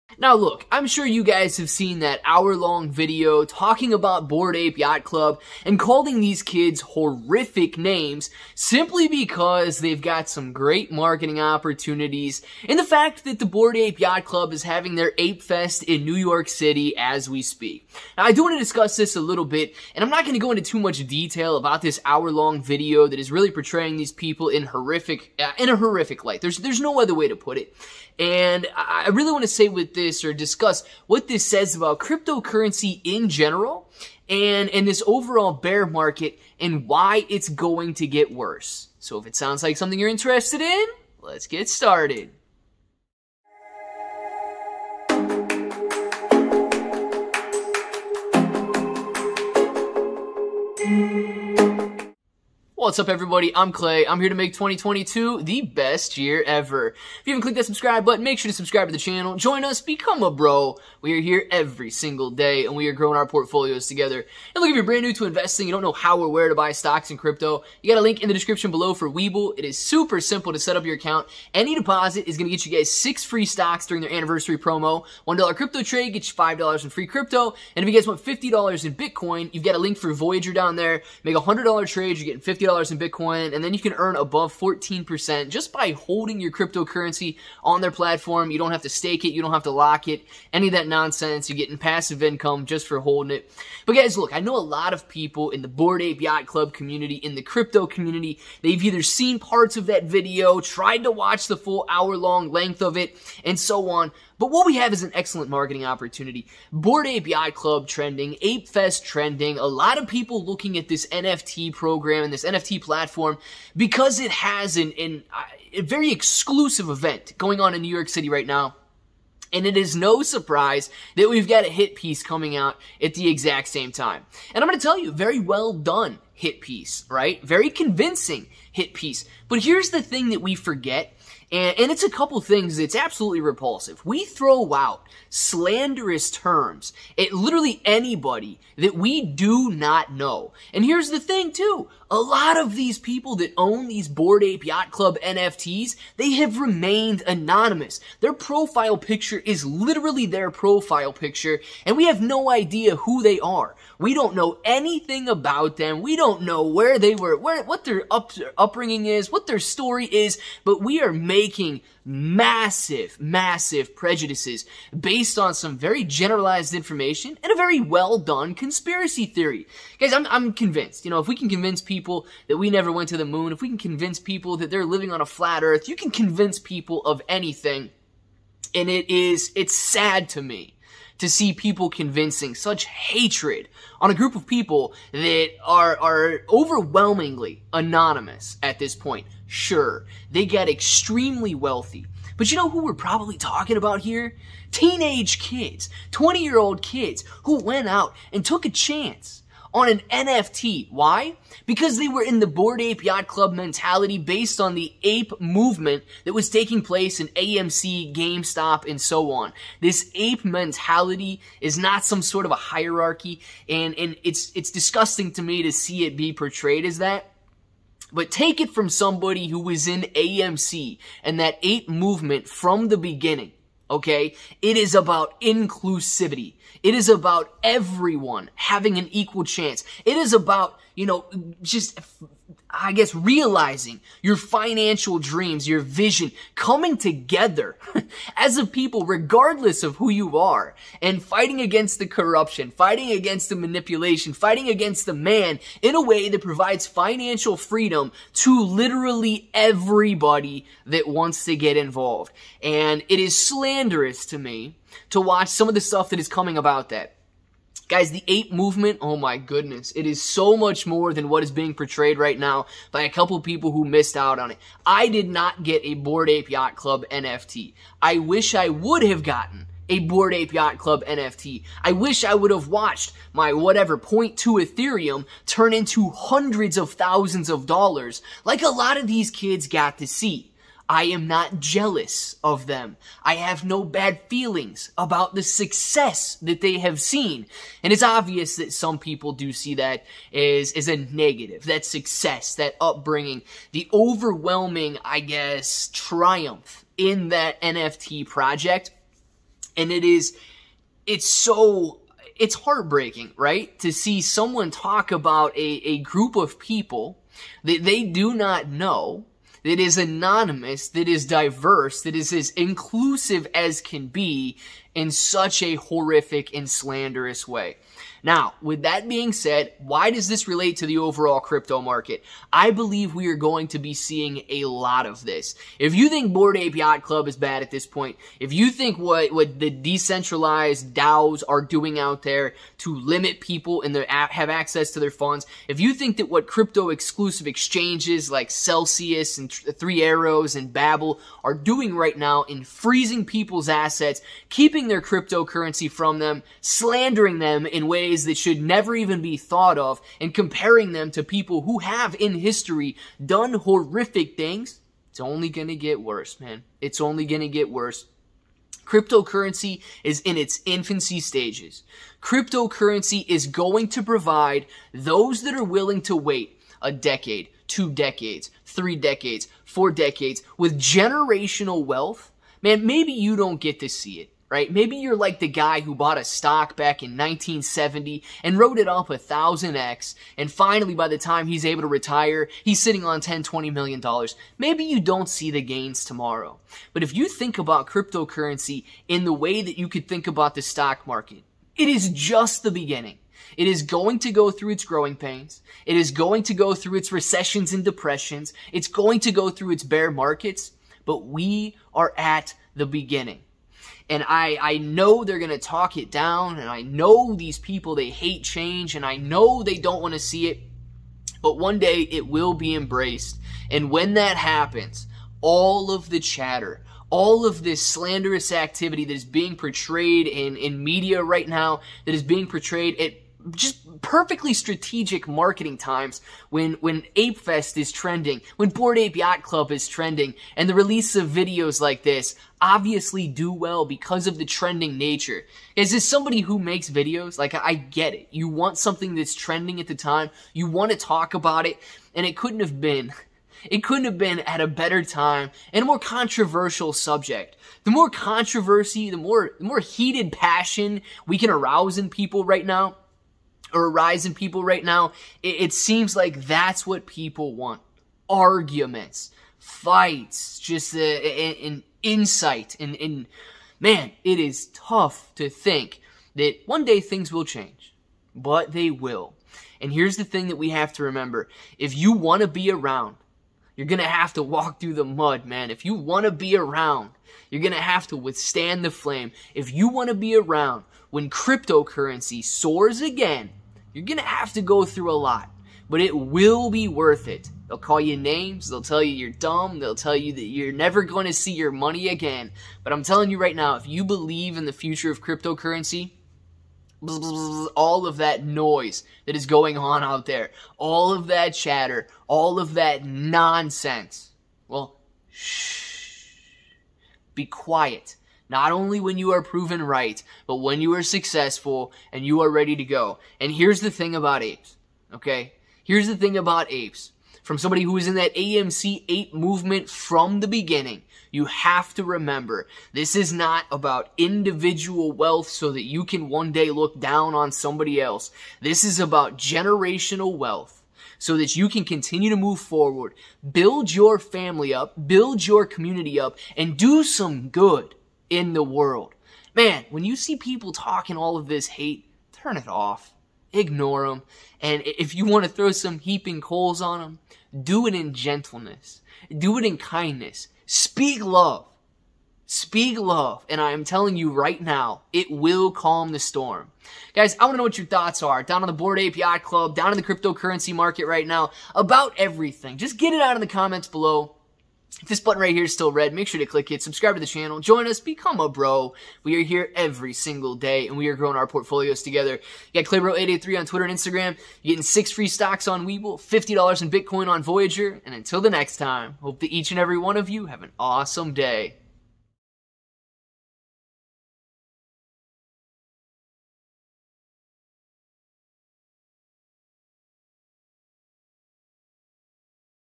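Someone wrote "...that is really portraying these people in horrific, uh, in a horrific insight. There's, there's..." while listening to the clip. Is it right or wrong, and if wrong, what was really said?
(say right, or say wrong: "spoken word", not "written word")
wrong: "light", not "insight".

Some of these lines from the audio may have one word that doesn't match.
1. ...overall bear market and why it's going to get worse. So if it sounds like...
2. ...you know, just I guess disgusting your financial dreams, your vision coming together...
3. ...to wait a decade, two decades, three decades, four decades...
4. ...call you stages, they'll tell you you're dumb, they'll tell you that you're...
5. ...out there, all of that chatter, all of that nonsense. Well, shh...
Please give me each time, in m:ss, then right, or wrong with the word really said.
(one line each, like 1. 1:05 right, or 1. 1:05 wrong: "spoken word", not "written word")
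1. 0:35 right
2. 3:50 wrong: "realizing", not "disgusting"
3. 6:06 right
4. 8:07 wrong: "names", not "stages"
5. 8:20 right.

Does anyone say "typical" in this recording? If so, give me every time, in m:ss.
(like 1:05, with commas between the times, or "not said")
not said.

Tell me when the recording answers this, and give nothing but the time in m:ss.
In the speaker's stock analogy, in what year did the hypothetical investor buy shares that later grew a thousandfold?
6:17.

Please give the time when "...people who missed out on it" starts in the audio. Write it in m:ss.
4:23.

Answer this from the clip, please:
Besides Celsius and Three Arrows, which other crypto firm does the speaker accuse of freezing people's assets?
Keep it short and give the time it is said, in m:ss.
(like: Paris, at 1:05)
Babel, at 5:40.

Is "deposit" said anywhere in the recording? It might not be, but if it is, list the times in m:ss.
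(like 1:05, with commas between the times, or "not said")
1:11.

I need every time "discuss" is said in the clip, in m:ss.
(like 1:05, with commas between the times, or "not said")
0:18, 0:30.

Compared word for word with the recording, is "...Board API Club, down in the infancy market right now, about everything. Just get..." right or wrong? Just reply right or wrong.
wrong.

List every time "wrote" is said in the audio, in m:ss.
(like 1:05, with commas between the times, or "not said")
6:18.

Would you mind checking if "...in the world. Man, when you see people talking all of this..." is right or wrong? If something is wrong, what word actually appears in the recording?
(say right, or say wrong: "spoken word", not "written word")
right.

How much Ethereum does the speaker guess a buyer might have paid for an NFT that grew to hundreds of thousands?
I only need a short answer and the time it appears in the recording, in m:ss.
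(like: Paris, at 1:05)
0.2 Ethereum, at 4:33.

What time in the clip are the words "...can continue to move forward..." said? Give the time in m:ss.
8:51.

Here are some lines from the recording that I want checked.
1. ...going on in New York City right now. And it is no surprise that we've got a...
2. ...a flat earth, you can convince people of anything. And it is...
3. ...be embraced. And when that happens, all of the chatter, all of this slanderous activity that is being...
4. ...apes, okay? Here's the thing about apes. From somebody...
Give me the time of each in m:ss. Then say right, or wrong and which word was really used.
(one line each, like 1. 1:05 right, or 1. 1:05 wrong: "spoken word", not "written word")
1. 1:57 right
2. 2:55 right
3. 6:52 right
4. 8:34 right.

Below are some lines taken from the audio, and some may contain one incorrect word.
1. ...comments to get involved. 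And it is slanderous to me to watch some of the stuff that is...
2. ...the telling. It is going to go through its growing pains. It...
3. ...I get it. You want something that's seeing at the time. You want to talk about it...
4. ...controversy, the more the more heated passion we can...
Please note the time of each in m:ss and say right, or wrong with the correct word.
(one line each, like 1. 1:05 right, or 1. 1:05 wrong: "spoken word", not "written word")
1. 4:11 wrong: "wants", not "comments"
2. 6:32 wrong: "beginning", not "telling"
3. 7:17 wrong: "trending", not "seeing"
4. 7:28 right.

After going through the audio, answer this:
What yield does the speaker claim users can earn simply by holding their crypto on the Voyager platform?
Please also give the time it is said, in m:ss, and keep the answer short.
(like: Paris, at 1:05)
above 14%, at 1:24.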